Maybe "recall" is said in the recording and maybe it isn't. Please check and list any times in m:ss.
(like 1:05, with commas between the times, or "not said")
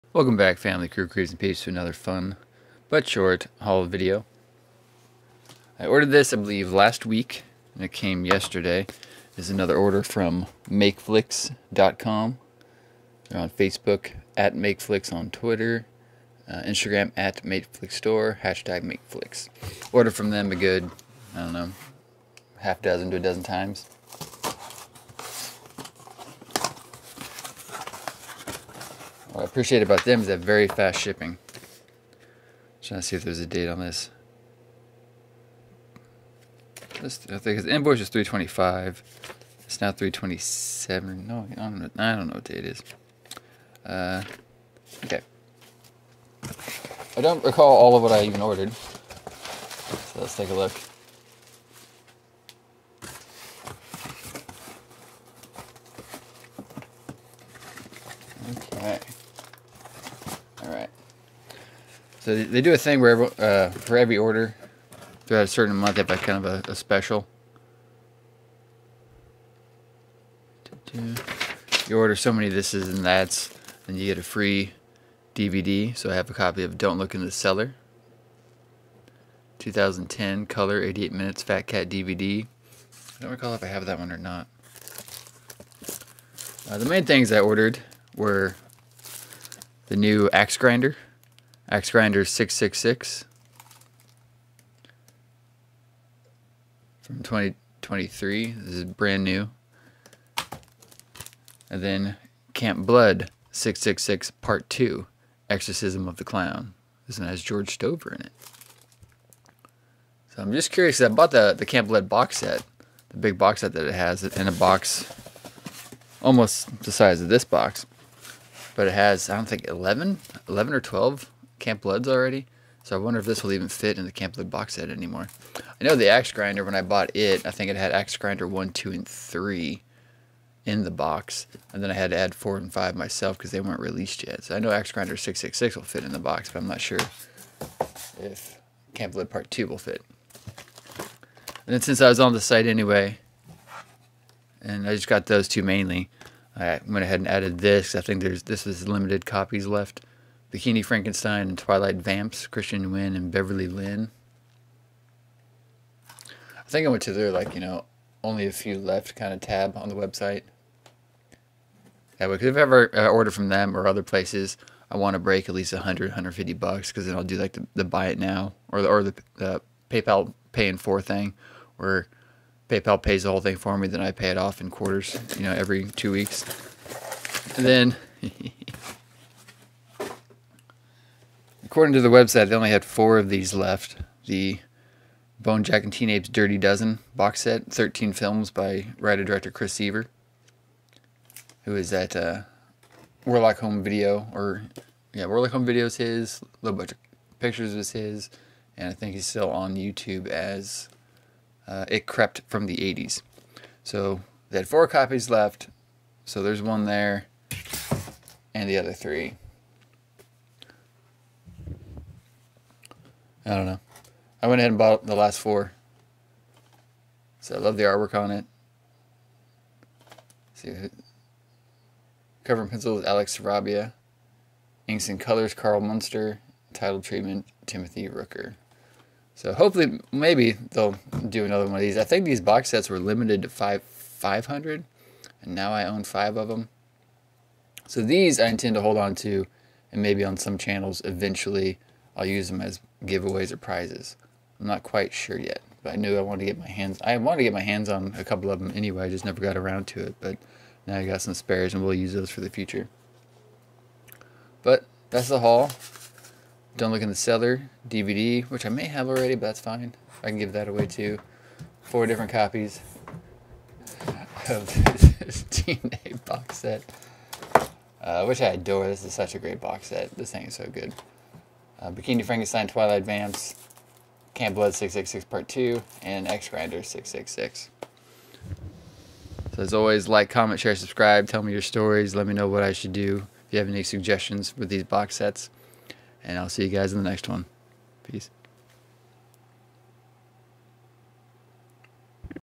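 0:47, 1:23.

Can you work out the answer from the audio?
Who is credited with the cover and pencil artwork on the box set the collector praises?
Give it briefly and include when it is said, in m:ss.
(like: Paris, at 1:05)
Alex Sarabia, at 3:43.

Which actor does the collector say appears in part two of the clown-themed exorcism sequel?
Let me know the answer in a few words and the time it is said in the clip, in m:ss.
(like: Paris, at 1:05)
George Stover, at 1:47.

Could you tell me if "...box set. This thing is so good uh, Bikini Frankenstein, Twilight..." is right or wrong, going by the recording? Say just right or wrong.
right.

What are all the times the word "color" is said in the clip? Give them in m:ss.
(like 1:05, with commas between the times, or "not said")
1:20, 3:45.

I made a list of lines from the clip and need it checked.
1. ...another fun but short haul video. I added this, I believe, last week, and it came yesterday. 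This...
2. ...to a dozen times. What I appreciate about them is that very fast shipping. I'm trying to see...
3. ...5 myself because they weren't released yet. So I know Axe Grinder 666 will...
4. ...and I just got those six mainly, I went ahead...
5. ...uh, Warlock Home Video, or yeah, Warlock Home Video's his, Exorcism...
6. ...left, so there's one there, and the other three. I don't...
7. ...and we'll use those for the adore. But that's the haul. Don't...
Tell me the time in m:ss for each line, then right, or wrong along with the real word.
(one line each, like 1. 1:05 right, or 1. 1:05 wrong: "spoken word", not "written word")
1. 0:01 wrong: "ordered", not "added"
2. 0:23 right
3. 2:12 right
4. 2:24 wrong: "two", not "six"
5. 3:12 wrong: "Low", not "Exorcism"
6. 3:25 right
7. 4:11 wrong: "future", not "adore".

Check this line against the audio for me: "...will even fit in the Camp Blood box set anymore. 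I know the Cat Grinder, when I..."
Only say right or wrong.
wrong.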